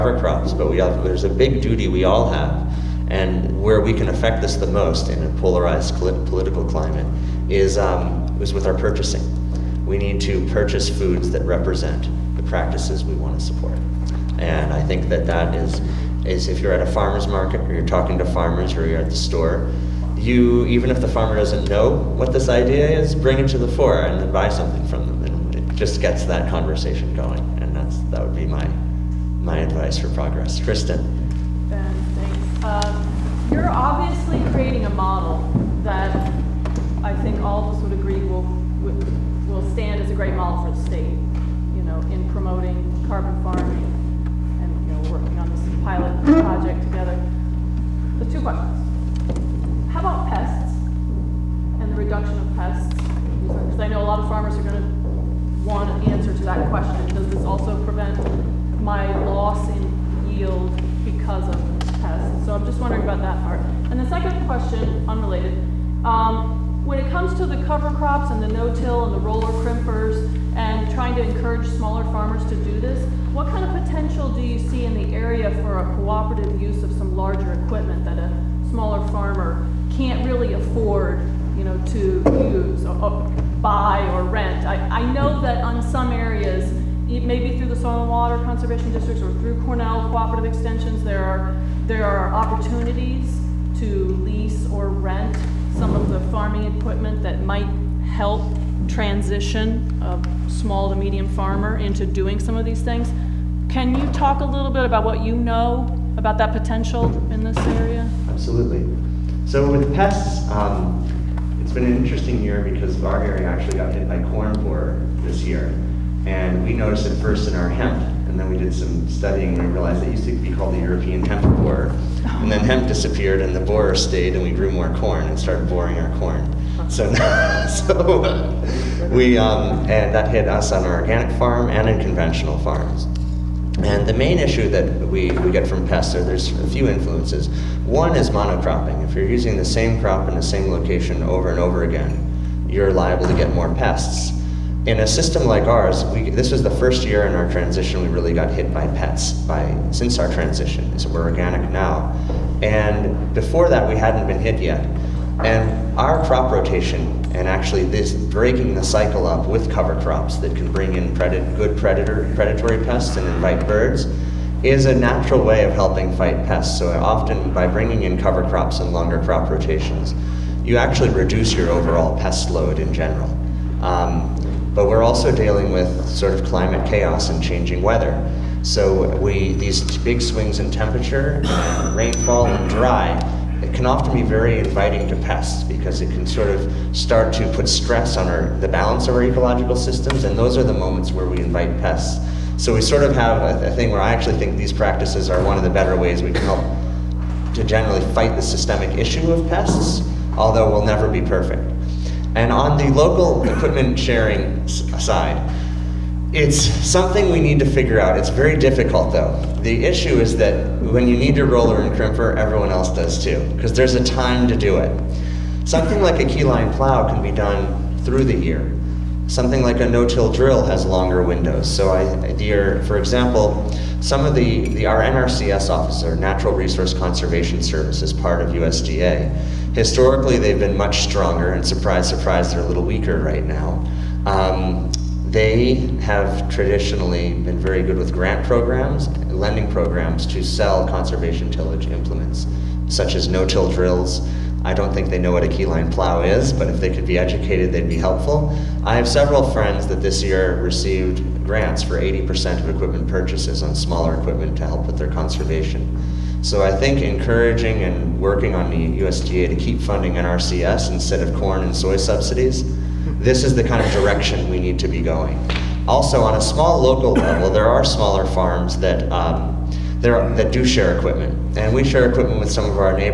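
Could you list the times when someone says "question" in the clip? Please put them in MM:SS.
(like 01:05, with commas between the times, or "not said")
00:48, 00:56, 01:04.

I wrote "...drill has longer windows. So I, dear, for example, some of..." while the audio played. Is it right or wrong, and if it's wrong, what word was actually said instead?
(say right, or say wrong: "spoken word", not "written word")
right.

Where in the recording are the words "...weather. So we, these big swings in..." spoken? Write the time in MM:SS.
02:57.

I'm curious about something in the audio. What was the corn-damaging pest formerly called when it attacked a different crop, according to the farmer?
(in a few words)
European hemp borer.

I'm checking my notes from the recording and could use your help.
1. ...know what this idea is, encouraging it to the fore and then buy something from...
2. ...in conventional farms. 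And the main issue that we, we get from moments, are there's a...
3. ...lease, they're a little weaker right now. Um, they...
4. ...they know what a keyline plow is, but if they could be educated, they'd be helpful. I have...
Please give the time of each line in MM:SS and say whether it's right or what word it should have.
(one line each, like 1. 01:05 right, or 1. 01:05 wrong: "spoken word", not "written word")
1. 00:21 wrong: "bring", not "encouraging"
2. 02:11 wrong: "pests", not "moments"
3. 03:52 wrong: "surprise", not "lease"
4. 04:05 right.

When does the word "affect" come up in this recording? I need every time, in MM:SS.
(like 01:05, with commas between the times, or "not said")
00:04.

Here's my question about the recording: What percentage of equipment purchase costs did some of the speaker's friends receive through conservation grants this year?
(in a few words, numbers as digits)
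80%.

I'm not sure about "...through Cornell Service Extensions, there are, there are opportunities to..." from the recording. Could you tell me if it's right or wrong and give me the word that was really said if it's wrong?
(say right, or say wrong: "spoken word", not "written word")
wrong: "Cooperative", not "Service".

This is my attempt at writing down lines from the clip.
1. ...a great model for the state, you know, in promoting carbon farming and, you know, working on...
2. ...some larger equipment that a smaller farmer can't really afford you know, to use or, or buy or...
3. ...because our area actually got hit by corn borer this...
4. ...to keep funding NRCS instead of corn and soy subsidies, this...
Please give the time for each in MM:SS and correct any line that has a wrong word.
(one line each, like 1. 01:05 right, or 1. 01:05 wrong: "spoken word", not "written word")
1. 00:40 right
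2. 01:16 right
3. 01:52 right
4. 04:19 right.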